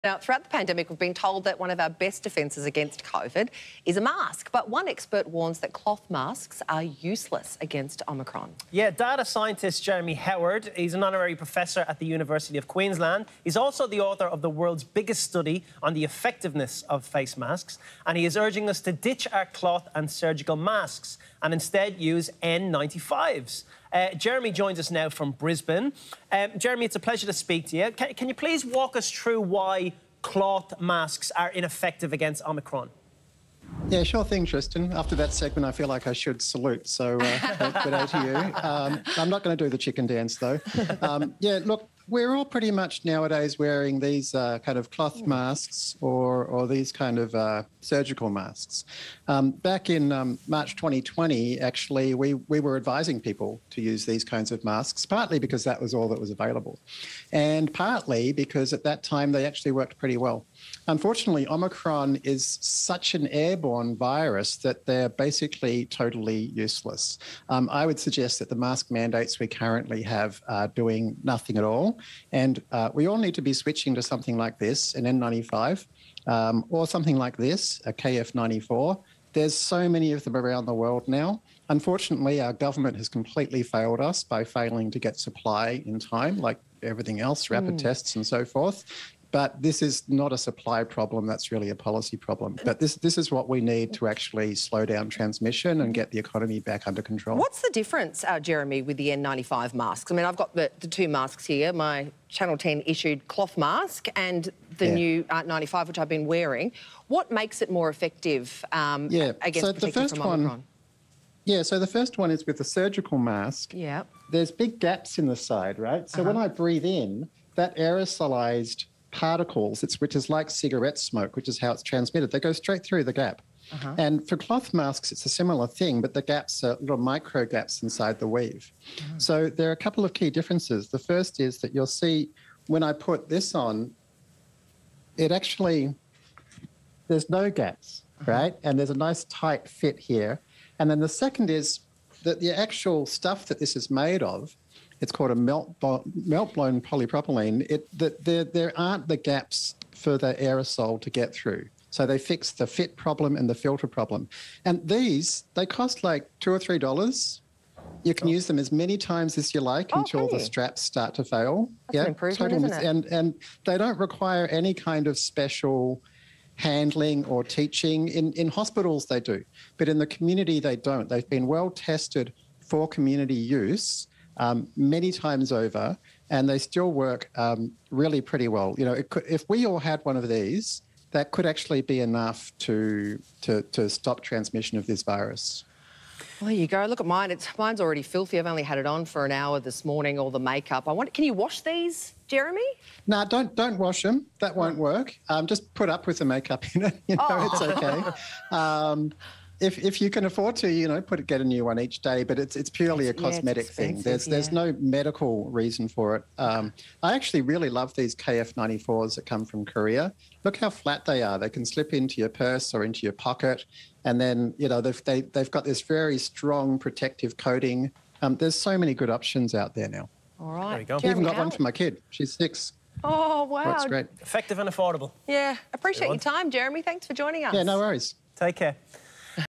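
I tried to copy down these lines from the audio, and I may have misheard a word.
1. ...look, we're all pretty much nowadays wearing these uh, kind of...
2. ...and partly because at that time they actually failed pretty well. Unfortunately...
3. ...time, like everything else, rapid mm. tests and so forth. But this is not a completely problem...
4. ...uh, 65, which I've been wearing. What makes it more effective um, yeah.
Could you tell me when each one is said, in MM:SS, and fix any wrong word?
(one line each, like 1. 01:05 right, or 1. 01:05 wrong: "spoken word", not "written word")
1. 00:41 right
2. 00:57 wrong: "worked", not "failed"
3. 01:25 wrong: "supply", not "completely"
4. 01:45 wrong: "95", not "65".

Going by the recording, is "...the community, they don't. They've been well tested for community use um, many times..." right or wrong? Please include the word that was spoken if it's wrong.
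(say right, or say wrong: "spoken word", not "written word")
right.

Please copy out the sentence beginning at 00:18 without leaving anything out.
And he is urging us to ditch our cloth and surgical masks and instead use N95s.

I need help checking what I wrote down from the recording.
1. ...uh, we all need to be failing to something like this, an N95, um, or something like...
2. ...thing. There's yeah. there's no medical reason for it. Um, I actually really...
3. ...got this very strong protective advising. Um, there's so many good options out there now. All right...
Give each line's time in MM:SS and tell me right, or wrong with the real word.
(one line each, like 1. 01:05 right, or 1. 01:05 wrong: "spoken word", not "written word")
1. 01:12 wrong: "switching", not "failing"
2. 03:23 right
3. 03:35 wrong: "coating", not "advising".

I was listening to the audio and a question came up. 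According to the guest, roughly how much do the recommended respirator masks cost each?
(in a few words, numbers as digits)
2 or 3 dollars.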